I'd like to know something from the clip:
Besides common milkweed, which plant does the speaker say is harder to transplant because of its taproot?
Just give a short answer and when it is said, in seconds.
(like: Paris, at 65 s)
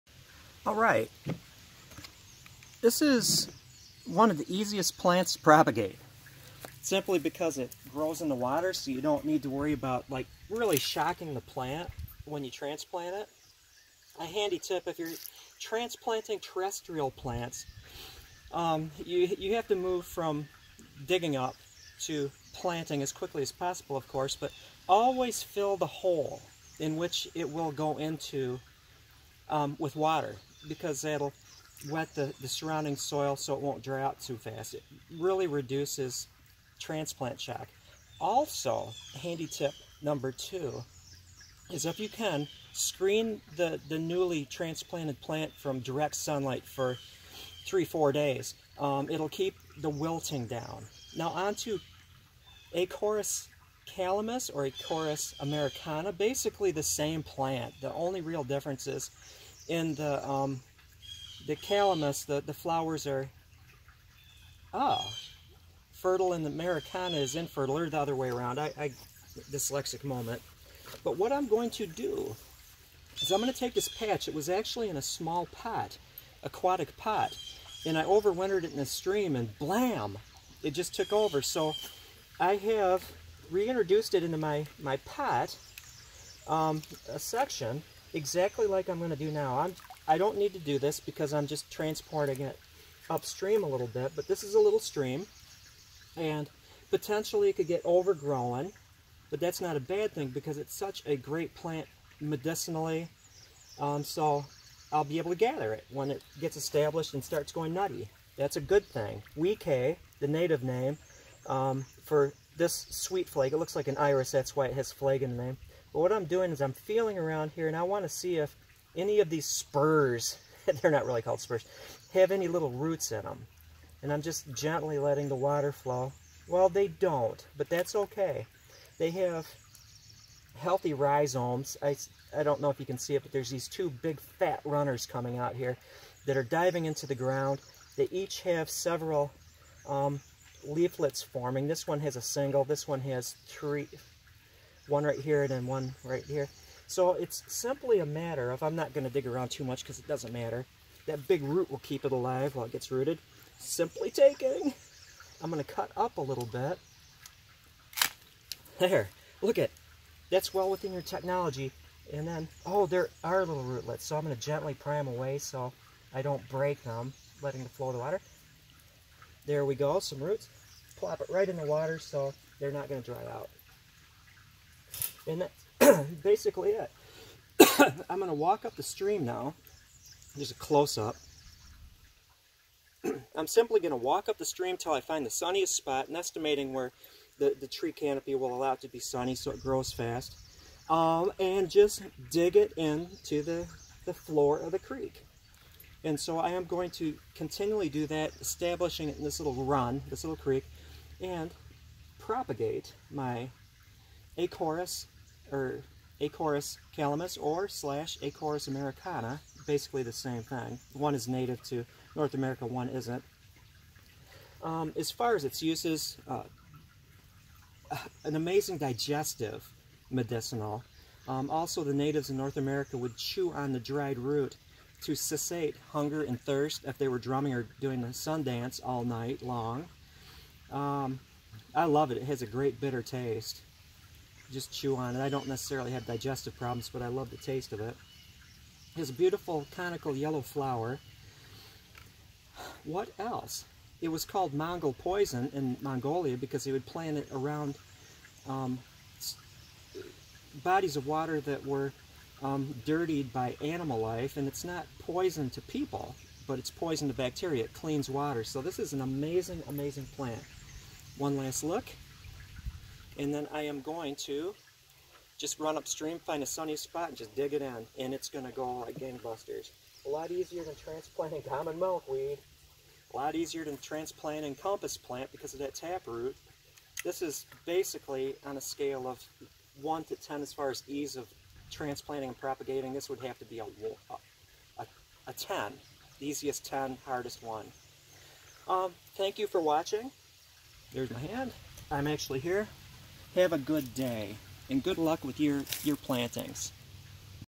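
Compass plant, at 274 s.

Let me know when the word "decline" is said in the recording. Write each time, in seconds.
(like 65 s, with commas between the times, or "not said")
not said.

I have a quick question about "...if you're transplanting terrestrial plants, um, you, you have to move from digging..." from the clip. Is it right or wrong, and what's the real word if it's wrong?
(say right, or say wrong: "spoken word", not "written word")
right.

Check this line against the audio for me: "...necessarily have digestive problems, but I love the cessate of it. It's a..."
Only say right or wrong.
wrong.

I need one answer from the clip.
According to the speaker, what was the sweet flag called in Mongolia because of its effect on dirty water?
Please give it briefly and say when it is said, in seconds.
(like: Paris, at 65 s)
Mongol poison, at 244 s.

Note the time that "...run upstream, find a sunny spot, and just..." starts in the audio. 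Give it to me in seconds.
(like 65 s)
265 s.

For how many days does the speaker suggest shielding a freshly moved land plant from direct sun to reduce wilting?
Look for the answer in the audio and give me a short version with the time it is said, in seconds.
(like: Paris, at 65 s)
3 to 4 days, at 47 s.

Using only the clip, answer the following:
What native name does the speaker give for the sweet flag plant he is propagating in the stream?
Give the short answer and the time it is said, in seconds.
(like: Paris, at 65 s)
Weekay, at 109 s.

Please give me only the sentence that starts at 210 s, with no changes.
One is native to North America, one isn't.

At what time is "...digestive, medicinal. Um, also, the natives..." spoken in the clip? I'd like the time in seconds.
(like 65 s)
218 s.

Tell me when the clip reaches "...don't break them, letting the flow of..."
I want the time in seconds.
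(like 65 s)
166 s.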